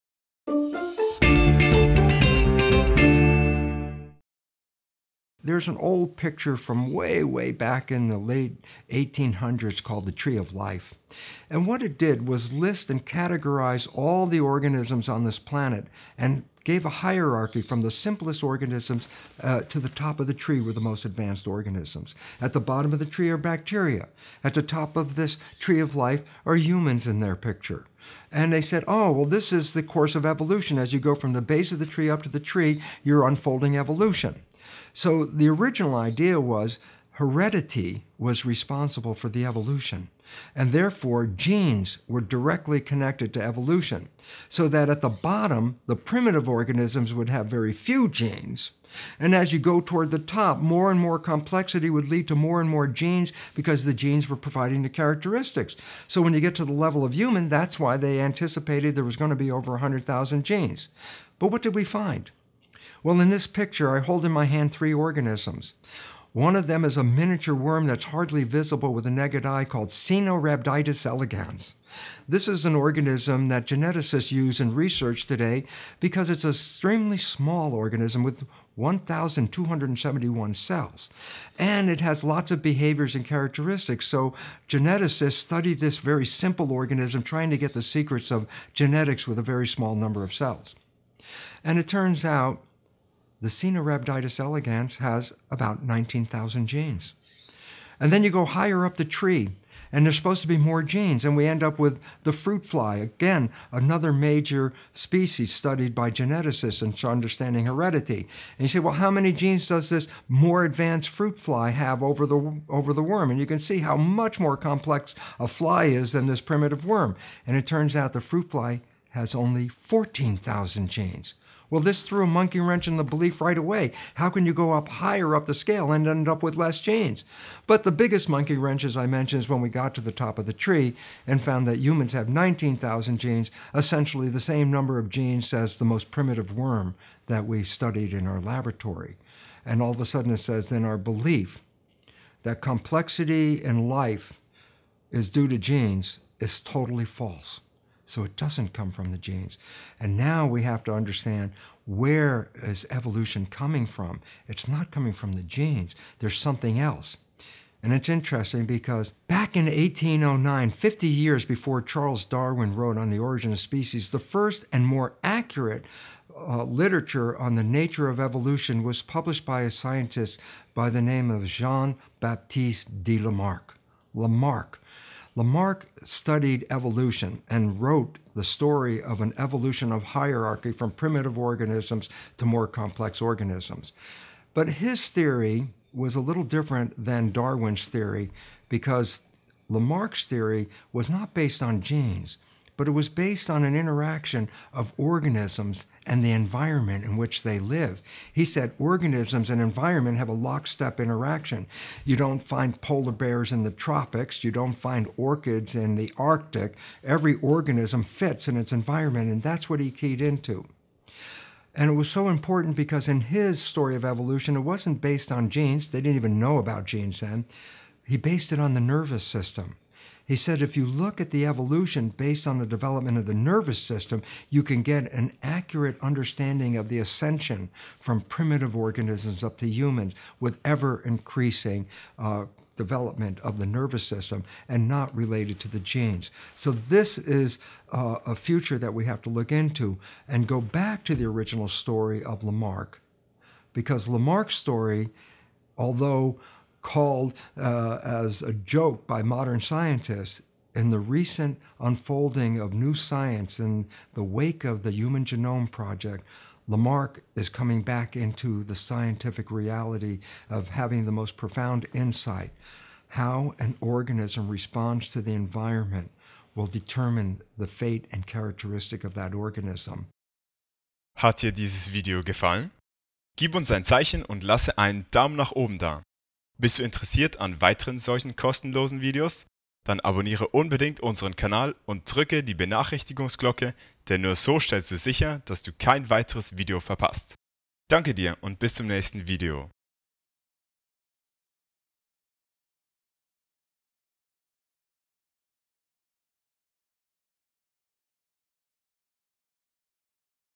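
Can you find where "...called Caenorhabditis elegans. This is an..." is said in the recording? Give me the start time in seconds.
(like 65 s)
69 s.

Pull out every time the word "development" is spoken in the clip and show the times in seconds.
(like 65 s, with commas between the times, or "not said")
222 s, 232 s.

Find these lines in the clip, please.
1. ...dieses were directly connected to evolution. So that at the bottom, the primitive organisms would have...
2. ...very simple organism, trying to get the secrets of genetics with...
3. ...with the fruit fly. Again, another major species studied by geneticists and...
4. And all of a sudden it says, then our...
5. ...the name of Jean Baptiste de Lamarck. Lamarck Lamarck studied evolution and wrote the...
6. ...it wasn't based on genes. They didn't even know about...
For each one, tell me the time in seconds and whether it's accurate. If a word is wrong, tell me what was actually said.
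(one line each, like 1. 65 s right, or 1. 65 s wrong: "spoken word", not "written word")
1. 41 s wrong: "genes", not "dieses"
2. 85 s right
3. 101 s right
4. 139 s right
5. 170 s right
6. 214 s right.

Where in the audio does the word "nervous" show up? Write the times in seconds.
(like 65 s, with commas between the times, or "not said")
218 s, 223 s, 233 s.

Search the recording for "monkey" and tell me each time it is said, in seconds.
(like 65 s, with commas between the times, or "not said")
122 s, 128 s.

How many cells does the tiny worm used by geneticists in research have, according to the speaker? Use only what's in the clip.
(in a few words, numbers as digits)
1,271.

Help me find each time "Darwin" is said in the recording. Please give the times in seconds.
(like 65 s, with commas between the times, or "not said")
162 s, 187 s.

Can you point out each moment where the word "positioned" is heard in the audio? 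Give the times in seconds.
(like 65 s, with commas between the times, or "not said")
not said.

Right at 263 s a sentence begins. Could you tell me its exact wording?
How an organism responds to the environment will determine the fate and characteristic of that organism.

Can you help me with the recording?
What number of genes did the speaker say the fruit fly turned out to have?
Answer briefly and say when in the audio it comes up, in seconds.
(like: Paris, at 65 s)
14,000, at 119 s.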